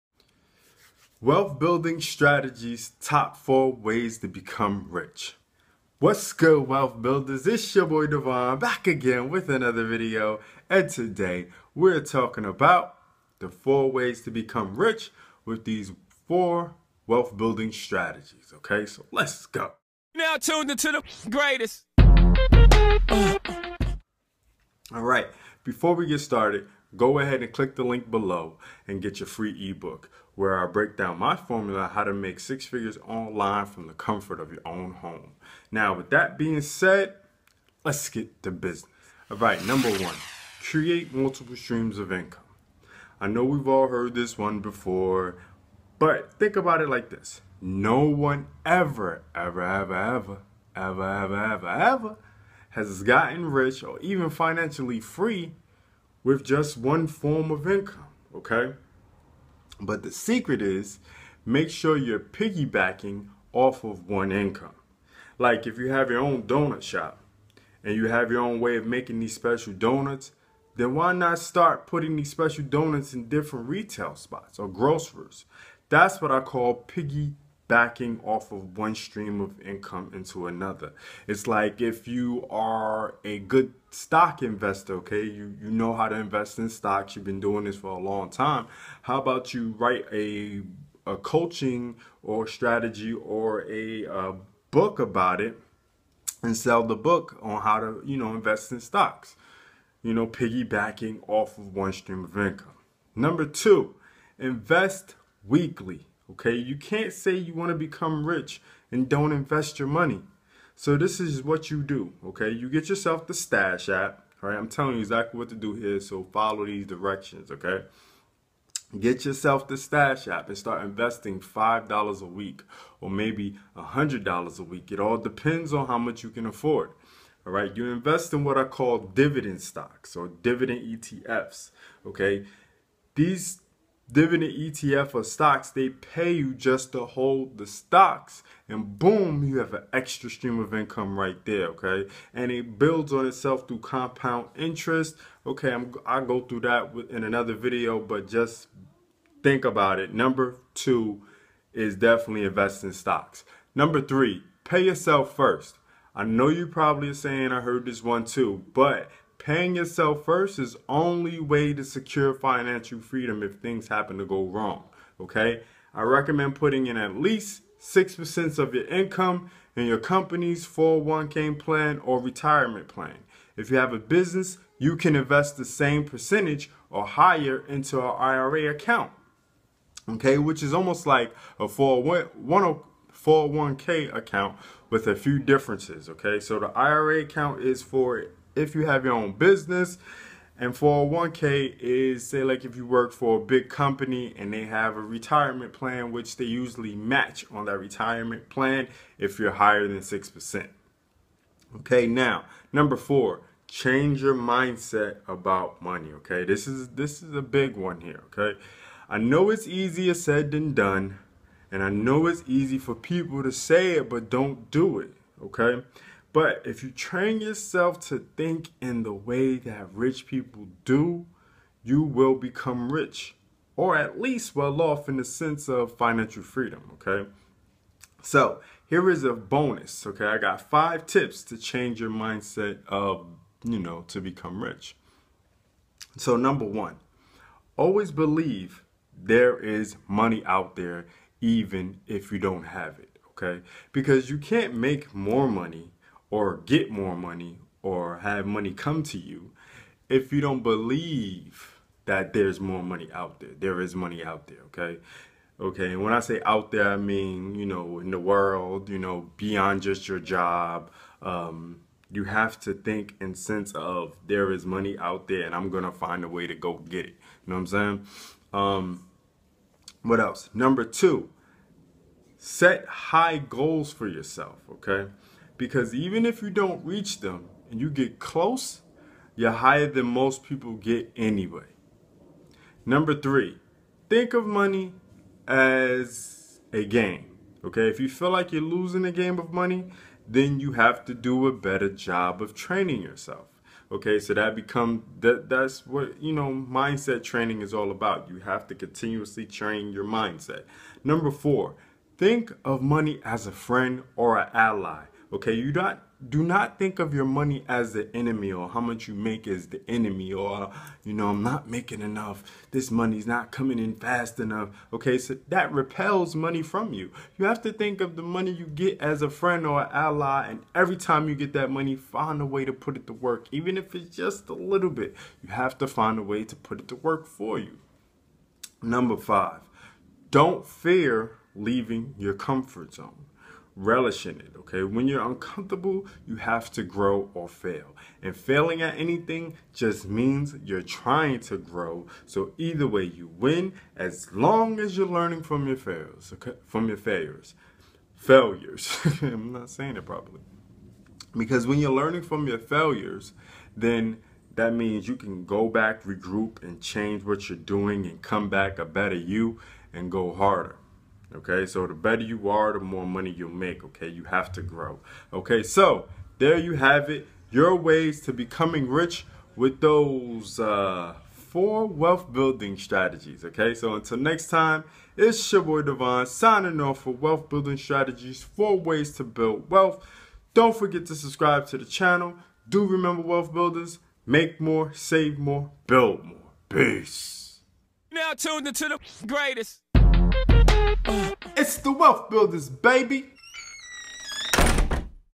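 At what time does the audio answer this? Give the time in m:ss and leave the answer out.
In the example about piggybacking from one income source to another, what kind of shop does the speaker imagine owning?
1:06.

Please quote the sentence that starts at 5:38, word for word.
And failing at anything just means you're trying to grow.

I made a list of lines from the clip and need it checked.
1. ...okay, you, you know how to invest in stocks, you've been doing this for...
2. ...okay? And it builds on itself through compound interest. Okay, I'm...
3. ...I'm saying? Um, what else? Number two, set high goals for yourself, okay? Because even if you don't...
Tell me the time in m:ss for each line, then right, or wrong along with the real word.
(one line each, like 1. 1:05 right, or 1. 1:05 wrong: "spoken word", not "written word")
1. 1:24 right
2. 2:21 right
3. 4:27 right.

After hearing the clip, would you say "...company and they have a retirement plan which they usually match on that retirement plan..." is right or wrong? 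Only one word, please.
right.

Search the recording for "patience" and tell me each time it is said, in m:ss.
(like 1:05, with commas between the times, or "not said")
not said.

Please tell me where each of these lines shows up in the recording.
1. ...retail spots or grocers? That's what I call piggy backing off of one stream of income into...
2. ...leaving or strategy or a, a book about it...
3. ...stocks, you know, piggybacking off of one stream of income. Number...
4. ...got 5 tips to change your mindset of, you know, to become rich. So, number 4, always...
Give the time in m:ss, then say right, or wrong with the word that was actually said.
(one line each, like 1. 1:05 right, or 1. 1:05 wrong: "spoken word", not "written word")
1. 1:13 right
2. 1:31 wrong: "coaching", not "leaving"
3. 1:38 right
4. 3:50 wrong: "1", not "4".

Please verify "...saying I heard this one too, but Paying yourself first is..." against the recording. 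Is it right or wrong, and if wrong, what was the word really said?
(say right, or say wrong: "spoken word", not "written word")
right.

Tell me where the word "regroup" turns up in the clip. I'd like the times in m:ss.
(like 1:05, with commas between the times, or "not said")
5:56.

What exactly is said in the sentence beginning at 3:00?
Which is almost like a 401k account with a few differences, okay?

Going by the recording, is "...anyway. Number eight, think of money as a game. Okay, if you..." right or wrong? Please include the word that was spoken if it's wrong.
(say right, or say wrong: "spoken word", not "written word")
wrong: "three", not "eight".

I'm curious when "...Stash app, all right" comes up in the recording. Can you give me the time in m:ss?
1:53.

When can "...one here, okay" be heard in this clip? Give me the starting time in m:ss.
3:27.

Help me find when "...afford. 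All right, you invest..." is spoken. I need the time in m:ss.
2:06.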